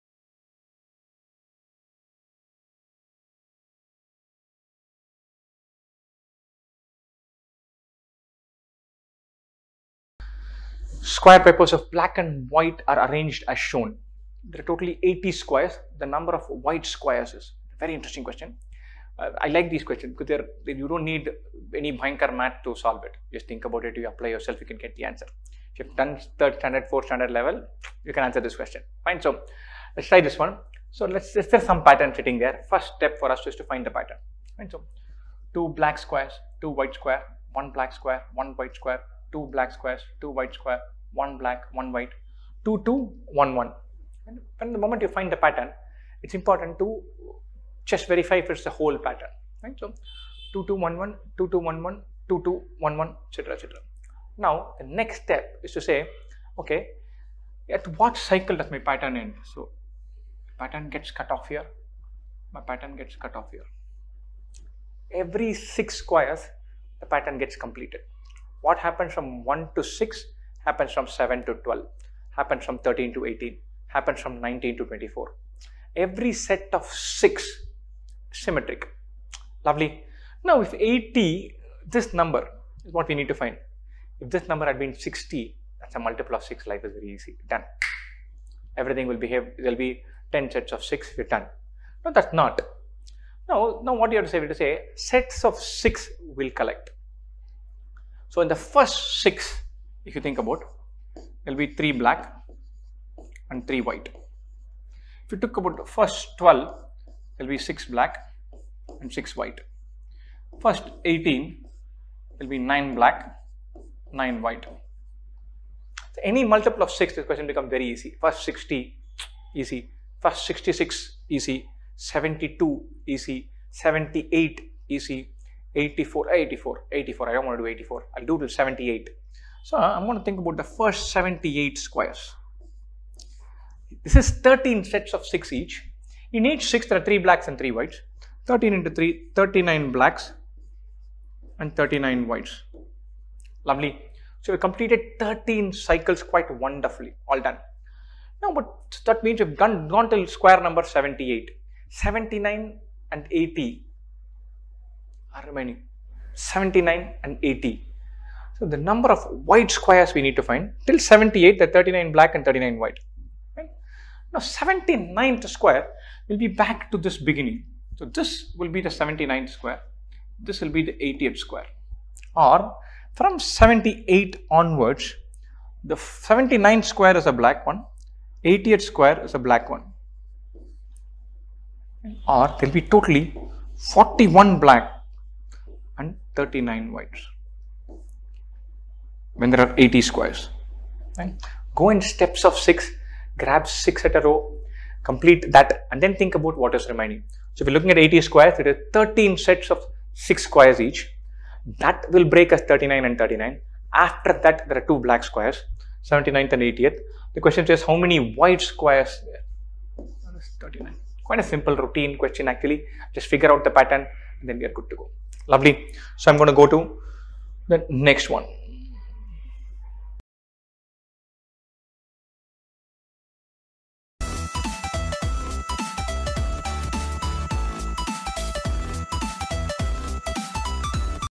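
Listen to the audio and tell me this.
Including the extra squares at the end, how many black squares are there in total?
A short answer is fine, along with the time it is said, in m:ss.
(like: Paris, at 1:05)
41, at 3:03.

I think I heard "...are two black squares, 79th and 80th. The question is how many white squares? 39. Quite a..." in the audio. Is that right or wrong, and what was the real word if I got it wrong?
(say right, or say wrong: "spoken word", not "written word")
right.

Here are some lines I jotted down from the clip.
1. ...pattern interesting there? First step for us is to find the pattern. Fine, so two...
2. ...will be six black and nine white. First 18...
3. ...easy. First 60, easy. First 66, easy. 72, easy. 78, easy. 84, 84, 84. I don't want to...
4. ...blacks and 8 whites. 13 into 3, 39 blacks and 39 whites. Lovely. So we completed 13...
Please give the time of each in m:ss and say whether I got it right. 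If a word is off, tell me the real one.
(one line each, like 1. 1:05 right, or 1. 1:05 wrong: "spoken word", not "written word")
1. 0:31 wrong: "sitting", not "interesting"
2. 1:47 wrong: "six", not "nine"
3. 1:57 right
4. 2:17 wrong: "3", not "8".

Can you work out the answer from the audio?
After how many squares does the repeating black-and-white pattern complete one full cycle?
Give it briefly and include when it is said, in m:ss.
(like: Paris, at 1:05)
6, at 1:05.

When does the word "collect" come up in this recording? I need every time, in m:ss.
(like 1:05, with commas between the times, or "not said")
1:36.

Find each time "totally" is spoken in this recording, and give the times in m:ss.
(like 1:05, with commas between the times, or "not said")
0:14, 3:02.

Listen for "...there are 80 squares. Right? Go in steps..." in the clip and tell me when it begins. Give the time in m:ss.
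3:09.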